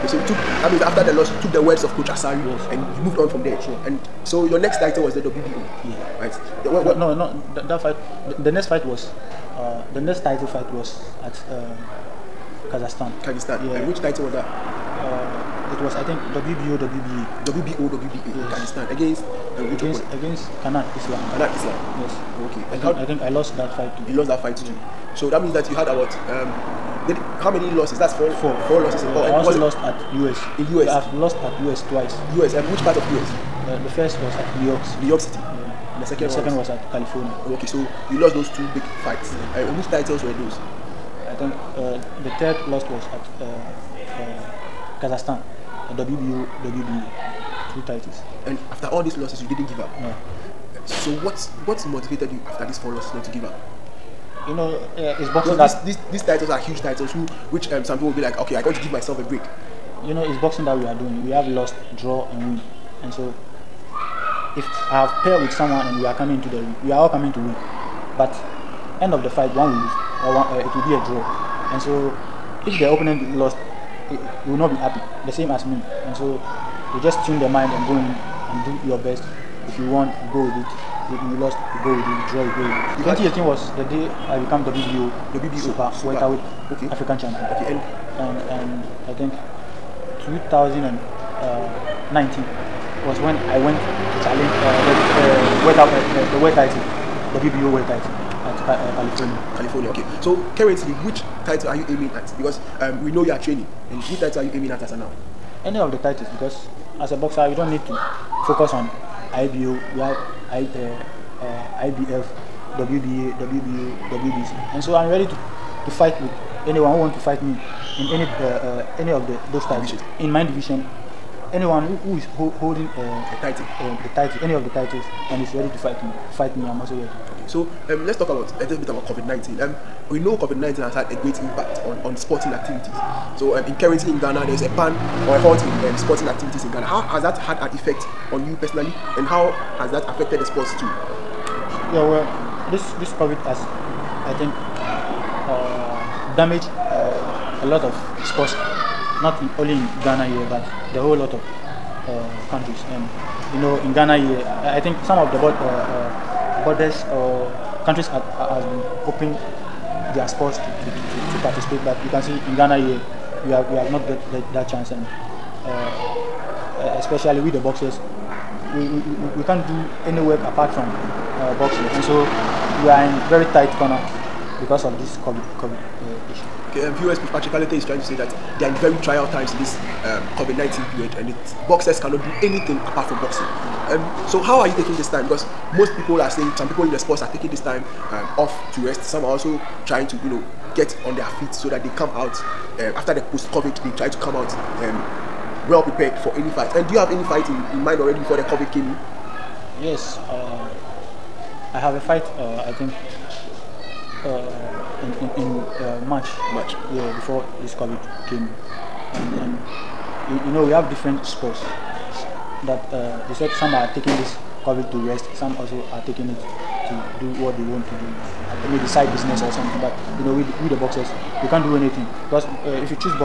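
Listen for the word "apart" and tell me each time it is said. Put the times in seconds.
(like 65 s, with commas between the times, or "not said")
170 s, 182 s.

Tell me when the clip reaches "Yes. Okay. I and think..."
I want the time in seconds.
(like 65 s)
22 s.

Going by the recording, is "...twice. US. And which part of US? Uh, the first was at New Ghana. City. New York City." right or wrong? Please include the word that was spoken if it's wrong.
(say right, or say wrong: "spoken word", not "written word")
wrong: "York", not "Ghana".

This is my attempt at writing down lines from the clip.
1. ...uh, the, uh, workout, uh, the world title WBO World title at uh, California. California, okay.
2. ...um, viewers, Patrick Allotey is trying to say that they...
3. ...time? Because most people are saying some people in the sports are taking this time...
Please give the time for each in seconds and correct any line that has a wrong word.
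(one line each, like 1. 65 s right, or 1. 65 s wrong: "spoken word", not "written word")
1. 94 s right
2. 176 s right
3. 185 s right.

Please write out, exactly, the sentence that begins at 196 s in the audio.
And do you have any fight in, in mind already before the COVID came in?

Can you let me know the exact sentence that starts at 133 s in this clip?
So um, in currently in Ghana, there's a ban or a halt in um, sporting activities in Ghana.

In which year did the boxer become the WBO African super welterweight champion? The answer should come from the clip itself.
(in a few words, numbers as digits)
2018.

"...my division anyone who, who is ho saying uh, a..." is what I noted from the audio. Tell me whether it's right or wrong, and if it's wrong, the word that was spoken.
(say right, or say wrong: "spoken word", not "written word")
wrong: "holding", not "saying".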